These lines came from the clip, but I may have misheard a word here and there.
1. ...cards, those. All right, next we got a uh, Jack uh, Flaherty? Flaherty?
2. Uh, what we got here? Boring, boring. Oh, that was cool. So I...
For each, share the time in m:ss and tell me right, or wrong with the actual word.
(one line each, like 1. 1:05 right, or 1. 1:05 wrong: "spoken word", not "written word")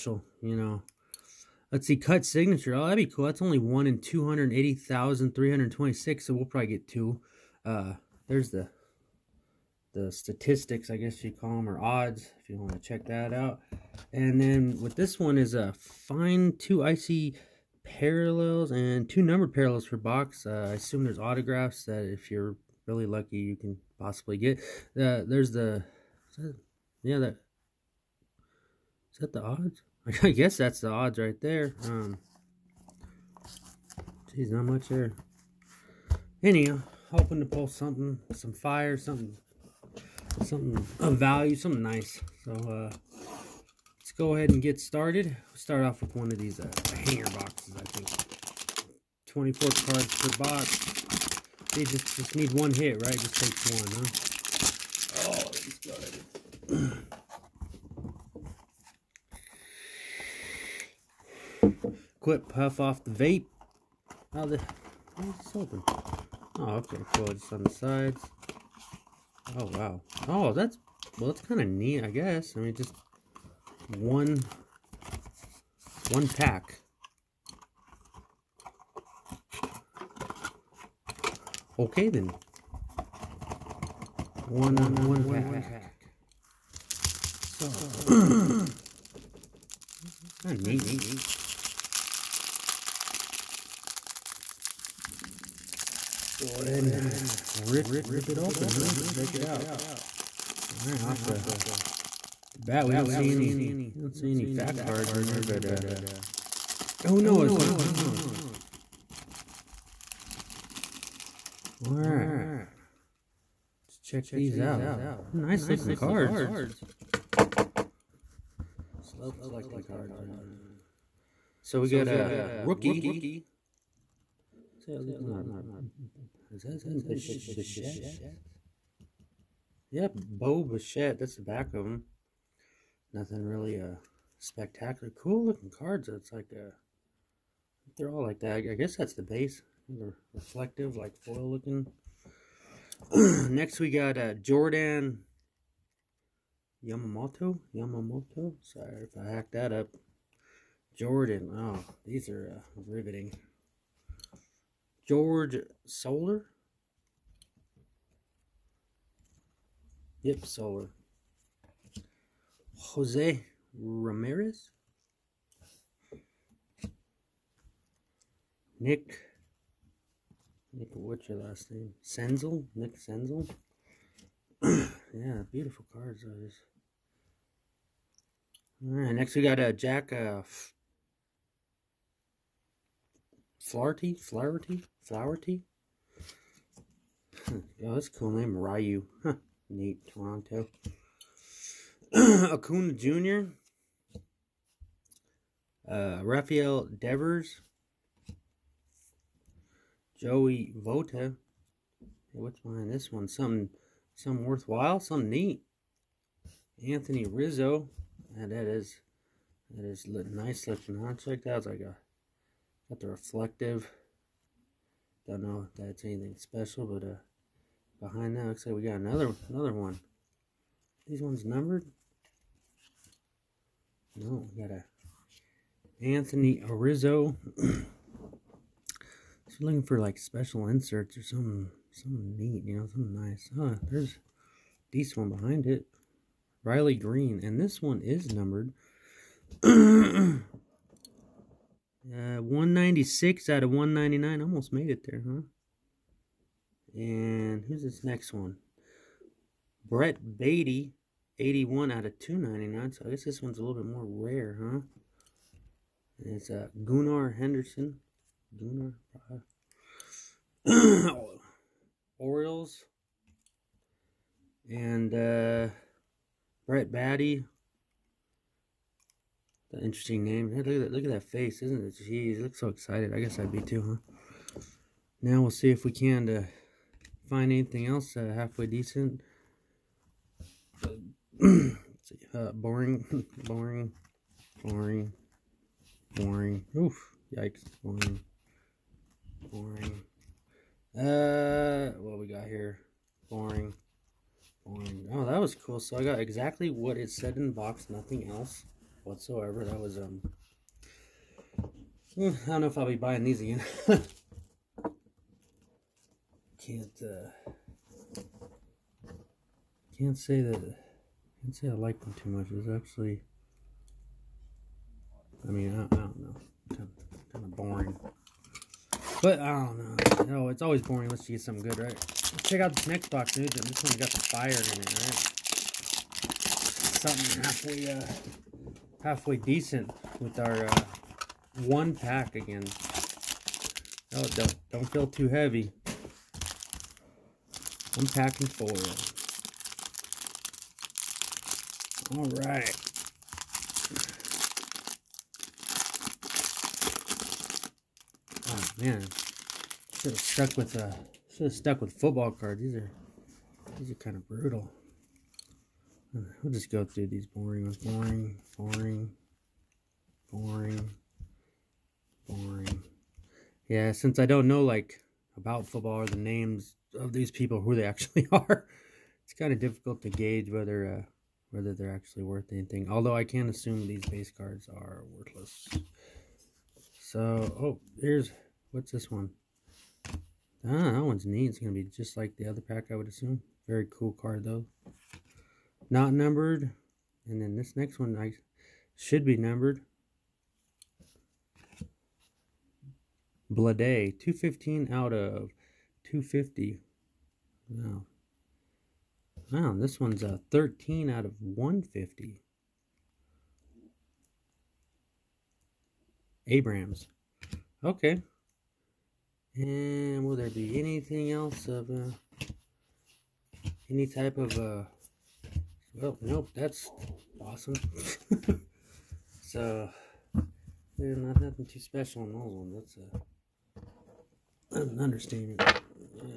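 1. 2:55 right
2. 4:50 right.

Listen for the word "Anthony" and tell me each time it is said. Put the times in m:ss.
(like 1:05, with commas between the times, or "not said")
3:26, 3:46.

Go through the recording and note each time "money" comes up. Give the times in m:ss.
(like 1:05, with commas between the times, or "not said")
not said.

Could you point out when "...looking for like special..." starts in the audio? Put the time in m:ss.
3:49.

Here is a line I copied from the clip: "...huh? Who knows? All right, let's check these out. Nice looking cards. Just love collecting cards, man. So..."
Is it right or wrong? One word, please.
right.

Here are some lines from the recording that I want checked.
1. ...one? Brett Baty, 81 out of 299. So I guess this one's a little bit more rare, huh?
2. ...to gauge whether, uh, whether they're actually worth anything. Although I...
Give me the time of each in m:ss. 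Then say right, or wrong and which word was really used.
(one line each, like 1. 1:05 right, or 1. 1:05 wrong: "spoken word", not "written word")
1. 4:08 right
2. 6:10 right.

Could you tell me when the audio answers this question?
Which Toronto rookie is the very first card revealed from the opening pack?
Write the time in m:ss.
2:10.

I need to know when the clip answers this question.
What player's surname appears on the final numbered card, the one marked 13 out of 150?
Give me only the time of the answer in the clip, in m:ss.
6:46.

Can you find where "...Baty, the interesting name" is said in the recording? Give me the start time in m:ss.
4:26.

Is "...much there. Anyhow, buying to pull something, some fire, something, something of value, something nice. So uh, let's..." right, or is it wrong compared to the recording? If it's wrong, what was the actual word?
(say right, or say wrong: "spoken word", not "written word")
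wrong: "hoping", not "buying".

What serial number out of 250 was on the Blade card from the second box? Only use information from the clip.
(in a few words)
215.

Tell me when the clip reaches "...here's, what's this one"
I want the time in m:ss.
6:18.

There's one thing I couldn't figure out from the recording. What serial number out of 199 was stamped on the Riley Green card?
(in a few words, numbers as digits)
196.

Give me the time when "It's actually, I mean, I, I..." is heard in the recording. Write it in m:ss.
5:12.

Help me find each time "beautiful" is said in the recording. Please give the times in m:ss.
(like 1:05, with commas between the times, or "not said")
2:55.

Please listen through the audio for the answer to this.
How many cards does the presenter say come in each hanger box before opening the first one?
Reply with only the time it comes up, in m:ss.
0:49.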